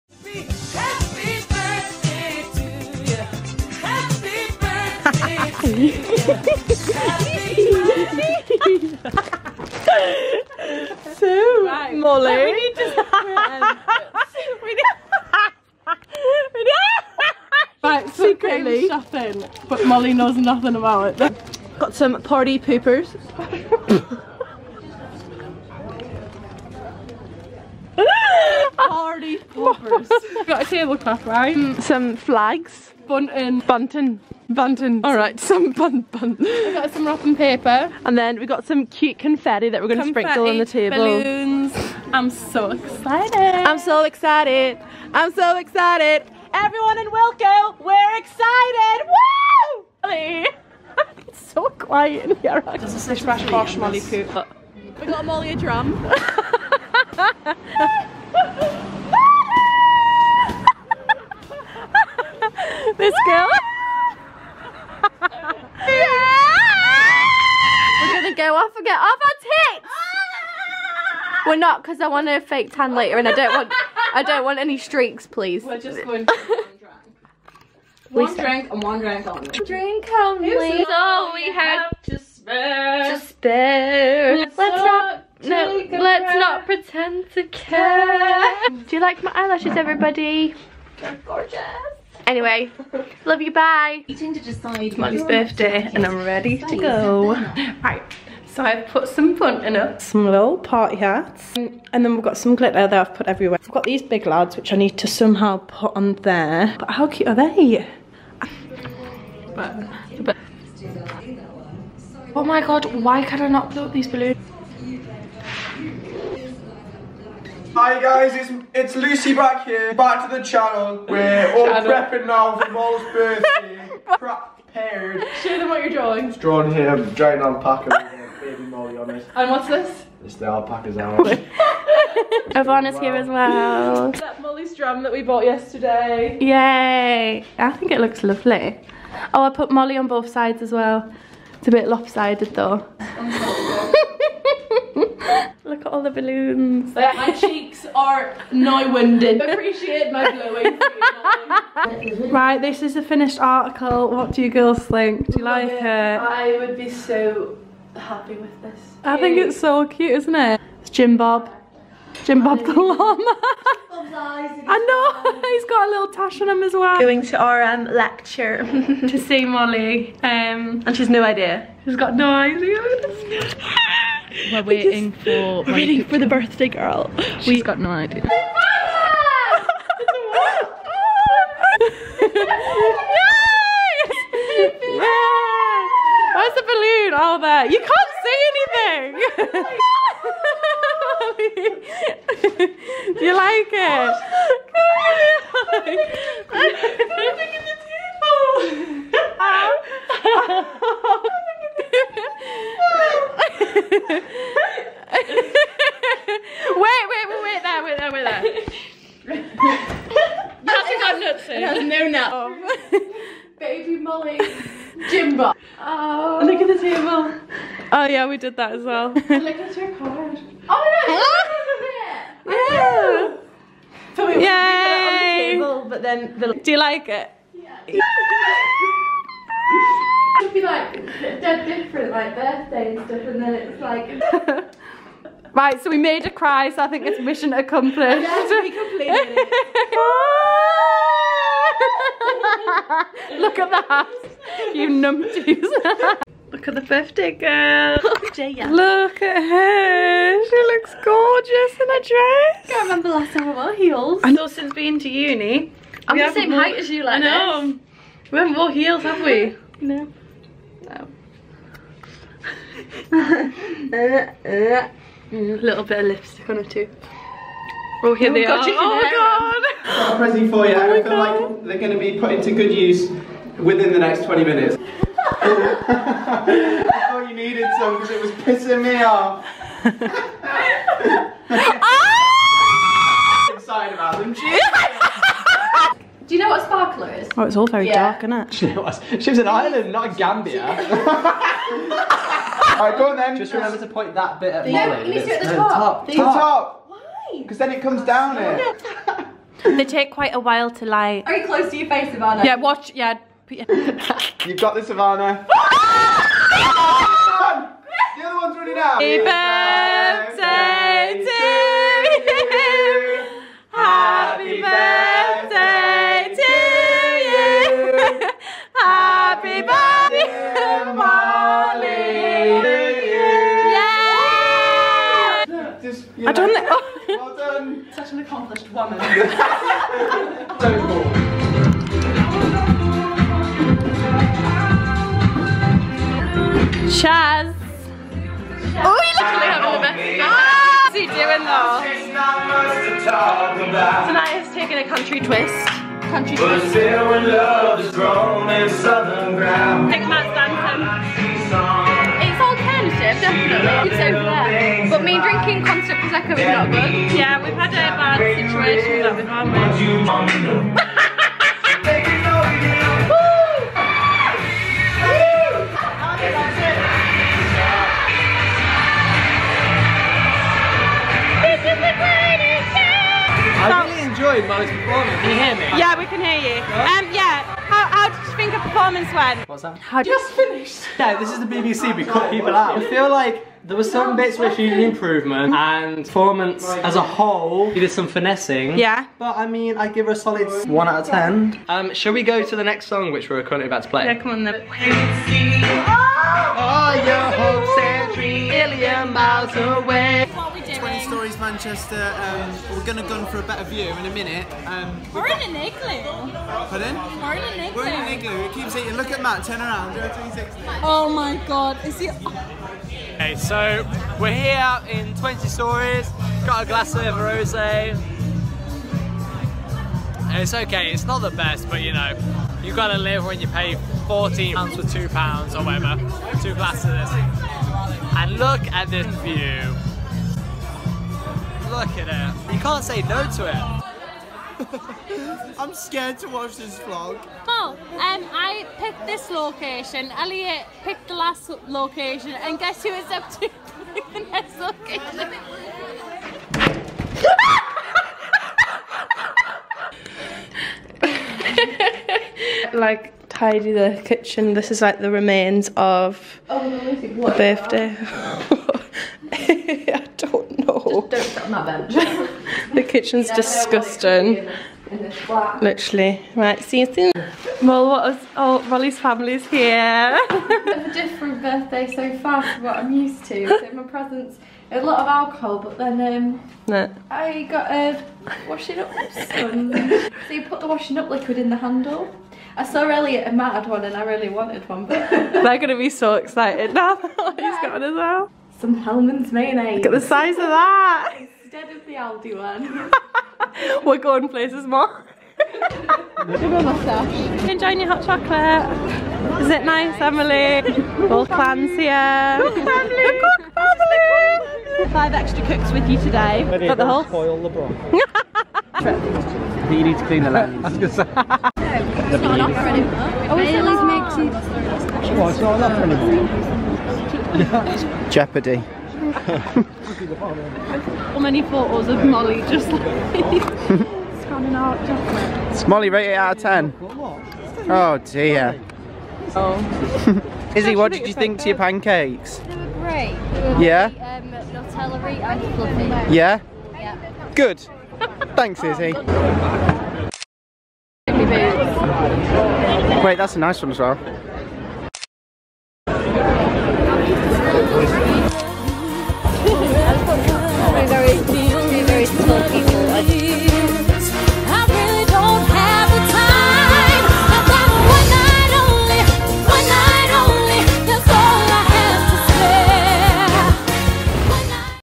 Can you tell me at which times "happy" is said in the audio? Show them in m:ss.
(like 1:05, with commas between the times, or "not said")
2:37, 5:08, 5:13, 5:18.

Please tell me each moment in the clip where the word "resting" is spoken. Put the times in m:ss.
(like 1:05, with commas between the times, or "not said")
not said.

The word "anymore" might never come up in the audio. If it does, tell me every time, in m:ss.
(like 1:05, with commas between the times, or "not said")
8:32, 8:37.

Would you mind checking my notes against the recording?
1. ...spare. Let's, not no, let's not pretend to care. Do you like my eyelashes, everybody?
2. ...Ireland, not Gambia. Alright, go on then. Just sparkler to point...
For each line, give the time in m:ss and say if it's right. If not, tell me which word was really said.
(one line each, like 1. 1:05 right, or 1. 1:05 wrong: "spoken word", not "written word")
1. 1:23 right
2. 4:49 wrong: "remember", not "sparkler".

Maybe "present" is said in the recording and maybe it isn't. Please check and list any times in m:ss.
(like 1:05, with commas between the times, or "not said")
4:30, 7:53.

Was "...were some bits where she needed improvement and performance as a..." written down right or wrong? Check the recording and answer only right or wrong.
right.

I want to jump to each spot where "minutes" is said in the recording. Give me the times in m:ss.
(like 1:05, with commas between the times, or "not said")
4:34, 6:44.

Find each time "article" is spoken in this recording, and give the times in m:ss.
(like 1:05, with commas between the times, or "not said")
2:33.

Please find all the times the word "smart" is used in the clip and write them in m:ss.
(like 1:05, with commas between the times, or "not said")
not said.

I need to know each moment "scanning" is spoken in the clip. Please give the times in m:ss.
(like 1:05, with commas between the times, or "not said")
8:44.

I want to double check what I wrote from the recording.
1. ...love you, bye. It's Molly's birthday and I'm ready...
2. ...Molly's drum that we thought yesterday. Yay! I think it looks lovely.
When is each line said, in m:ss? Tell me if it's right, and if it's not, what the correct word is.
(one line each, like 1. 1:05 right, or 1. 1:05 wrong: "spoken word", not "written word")
1. 1:33 right
2. 2:14 wrong: "bought", not "thought".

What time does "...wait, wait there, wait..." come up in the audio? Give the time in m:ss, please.
3:27.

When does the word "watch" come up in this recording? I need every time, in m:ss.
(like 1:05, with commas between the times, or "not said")
5:02, 7:16.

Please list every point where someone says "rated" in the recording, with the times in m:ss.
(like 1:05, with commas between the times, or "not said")
8:45.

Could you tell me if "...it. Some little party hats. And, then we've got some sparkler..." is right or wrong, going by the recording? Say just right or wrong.
wrong.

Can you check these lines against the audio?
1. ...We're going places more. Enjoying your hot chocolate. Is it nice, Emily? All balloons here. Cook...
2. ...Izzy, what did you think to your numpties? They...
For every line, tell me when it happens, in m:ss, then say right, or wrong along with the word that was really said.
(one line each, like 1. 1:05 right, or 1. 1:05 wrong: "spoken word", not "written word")
1. 8:13 wrong: "clans", not "balloons"
2. 8:50 wrong: "pancakes", not "numpties".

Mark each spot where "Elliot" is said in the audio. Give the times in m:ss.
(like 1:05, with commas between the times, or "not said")
7:20, 8:02.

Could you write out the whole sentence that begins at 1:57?
Hi guys, it's, it's Lucy back here, back to the channel.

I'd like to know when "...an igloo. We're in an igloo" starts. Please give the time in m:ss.
6:47.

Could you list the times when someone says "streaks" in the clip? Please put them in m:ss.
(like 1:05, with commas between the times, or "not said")
1:14.